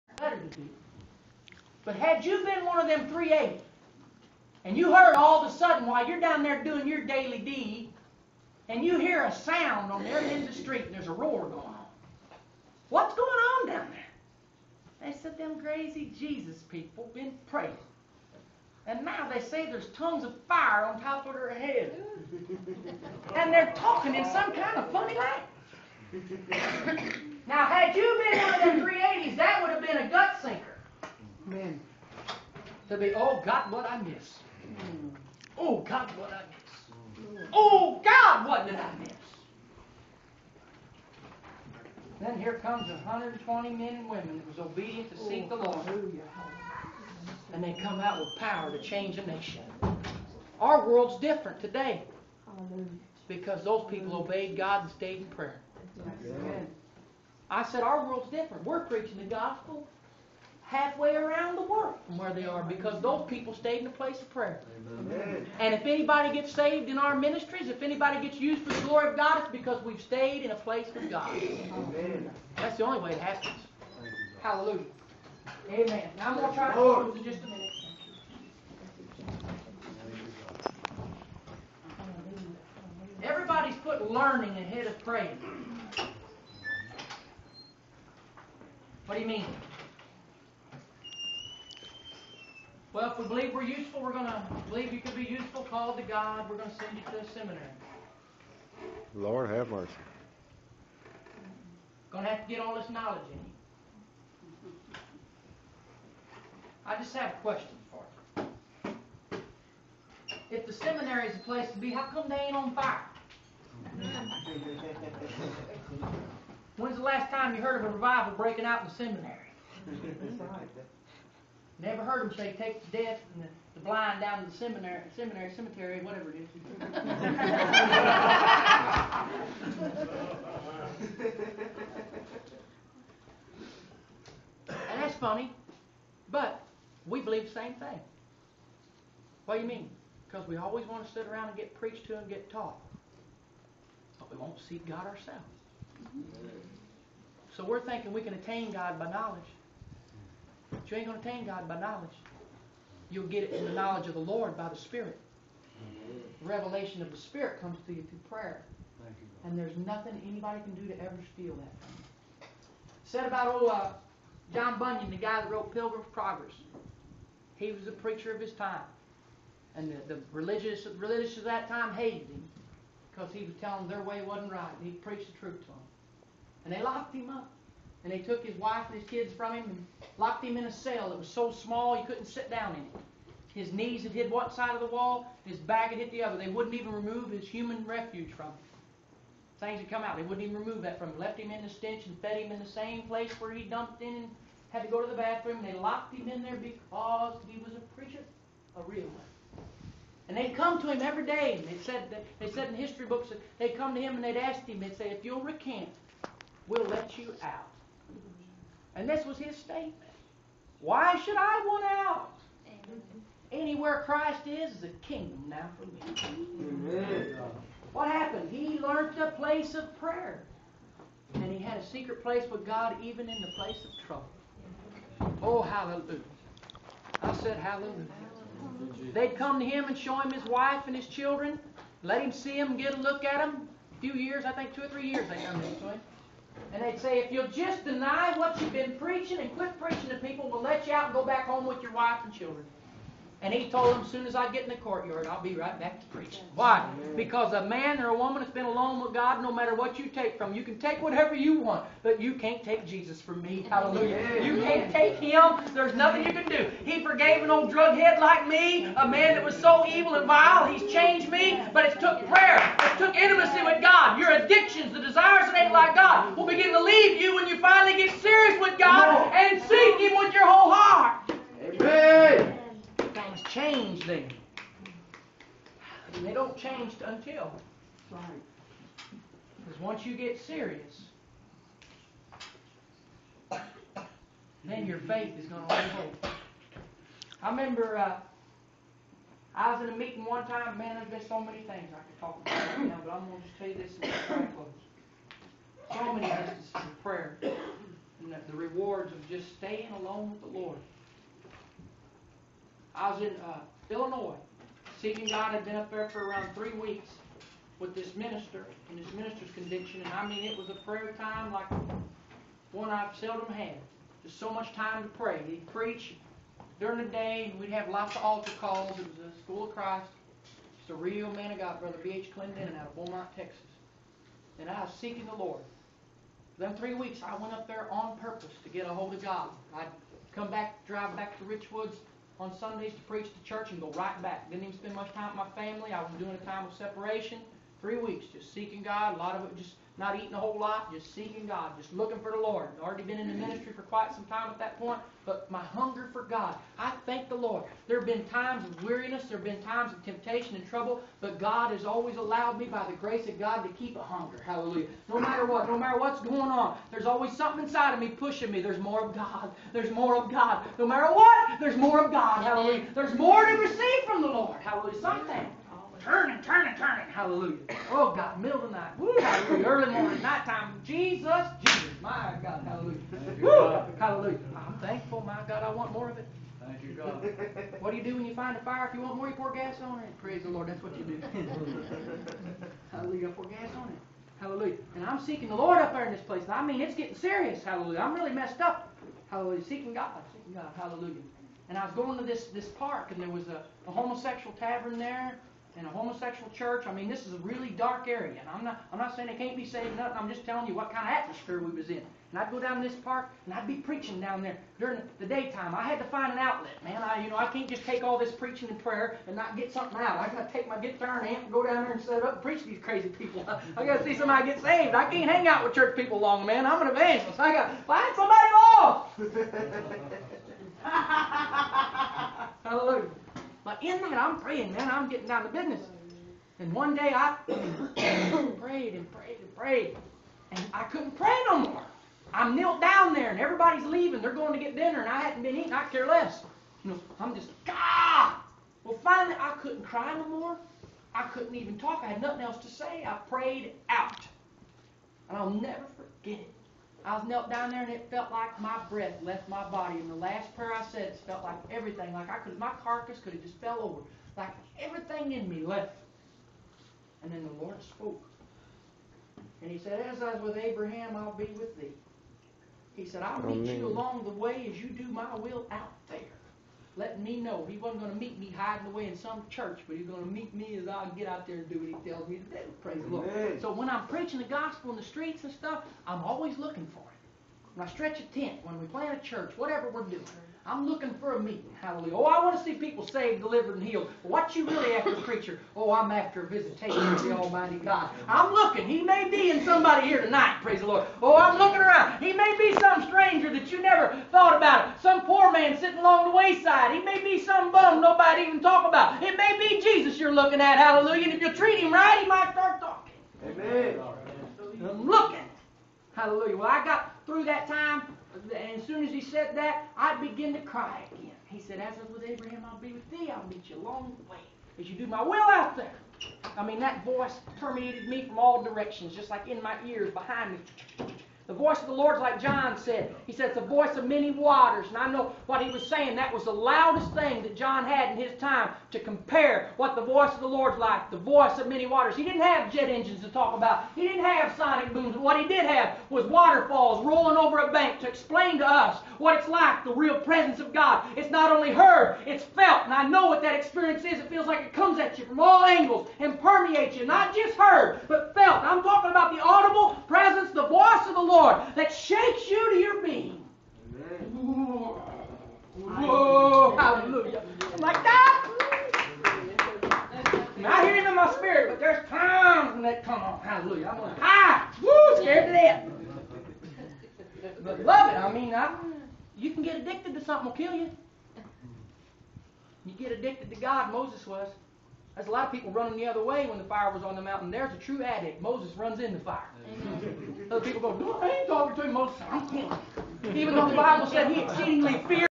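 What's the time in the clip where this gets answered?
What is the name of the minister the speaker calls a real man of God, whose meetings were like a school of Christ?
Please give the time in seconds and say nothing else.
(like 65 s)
322 s.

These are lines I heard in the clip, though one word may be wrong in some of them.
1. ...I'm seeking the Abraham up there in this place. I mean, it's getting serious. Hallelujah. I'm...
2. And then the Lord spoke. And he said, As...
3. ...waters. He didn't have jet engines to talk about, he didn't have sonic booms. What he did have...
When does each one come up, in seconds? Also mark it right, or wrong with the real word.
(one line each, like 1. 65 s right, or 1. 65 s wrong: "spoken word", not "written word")
1. 385 s wrong: "Lord", not "Abraham"
2. 457 s right
3. 531 s right.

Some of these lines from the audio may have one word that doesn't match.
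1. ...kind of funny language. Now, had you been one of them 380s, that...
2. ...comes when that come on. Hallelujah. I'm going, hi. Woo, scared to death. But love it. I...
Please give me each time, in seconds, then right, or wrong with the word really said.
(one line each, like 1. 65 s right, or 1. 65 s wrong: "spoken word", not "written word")
1. 24 s right
2. 562 s wrong: "times", not "comes".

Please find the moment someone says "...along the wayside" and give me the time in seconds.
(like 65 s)
496 s.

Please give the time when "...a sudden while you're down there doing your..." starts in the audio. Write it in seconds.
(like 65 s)
5 s.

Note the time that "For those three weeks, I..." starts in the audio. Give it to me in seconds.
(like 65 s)
326 s.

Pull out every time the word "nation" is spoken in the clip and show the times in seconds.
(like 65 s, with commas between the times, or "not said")
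49 s.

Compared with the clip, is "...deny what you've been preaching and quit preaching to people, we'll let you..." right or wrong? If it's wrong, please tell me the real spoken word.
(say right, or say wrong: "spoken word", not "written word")
right.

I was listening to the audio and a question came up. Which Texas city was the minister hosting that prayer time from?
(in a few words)
Beaumont.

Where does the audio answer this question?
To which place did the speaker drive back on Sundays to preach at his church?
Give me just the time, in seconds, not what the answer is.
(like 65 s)
331 s.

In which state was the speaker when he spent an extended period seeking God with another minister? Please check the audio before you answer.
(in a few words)
Illinois.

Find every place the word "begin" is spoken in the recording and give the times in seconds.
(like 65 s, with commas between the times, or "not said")
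266 s, 510 s.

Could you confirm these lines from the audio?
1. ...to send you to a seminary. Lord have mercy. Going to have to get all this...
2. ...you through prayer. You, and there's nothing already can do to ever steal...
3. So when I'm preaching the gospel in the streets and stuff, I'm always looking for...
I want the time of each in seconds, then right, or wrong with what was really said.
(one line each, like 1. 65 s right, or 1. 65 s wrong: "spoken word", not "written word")
1. 96 s right
2. 157 s wrong: "anybody", not "already"
3. 473 s right.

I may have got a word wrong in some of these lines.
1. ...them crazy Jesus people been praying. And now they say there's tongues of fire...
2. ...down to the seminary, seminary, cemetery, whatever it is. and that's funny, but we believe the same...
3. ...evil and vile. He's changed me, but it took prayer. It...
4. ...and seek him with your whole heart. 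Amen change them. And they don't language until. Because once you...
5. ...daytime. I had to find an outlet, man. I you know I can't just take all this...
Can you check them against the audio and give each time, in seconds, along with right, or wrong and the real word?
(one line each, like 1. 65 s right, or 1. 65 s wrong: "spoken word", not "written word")
1. 15 s right
2. 124 s right
3. 259 s right
4. 269 s wrong: "change", not "language"
5. 405 s right.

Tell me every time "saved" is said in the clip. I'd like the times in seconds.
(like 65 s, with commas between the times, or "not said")
66 s, 399 s, 414 s, 483 s.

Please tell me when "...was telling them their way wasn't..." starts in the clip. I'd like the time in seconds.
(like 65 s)
173 s.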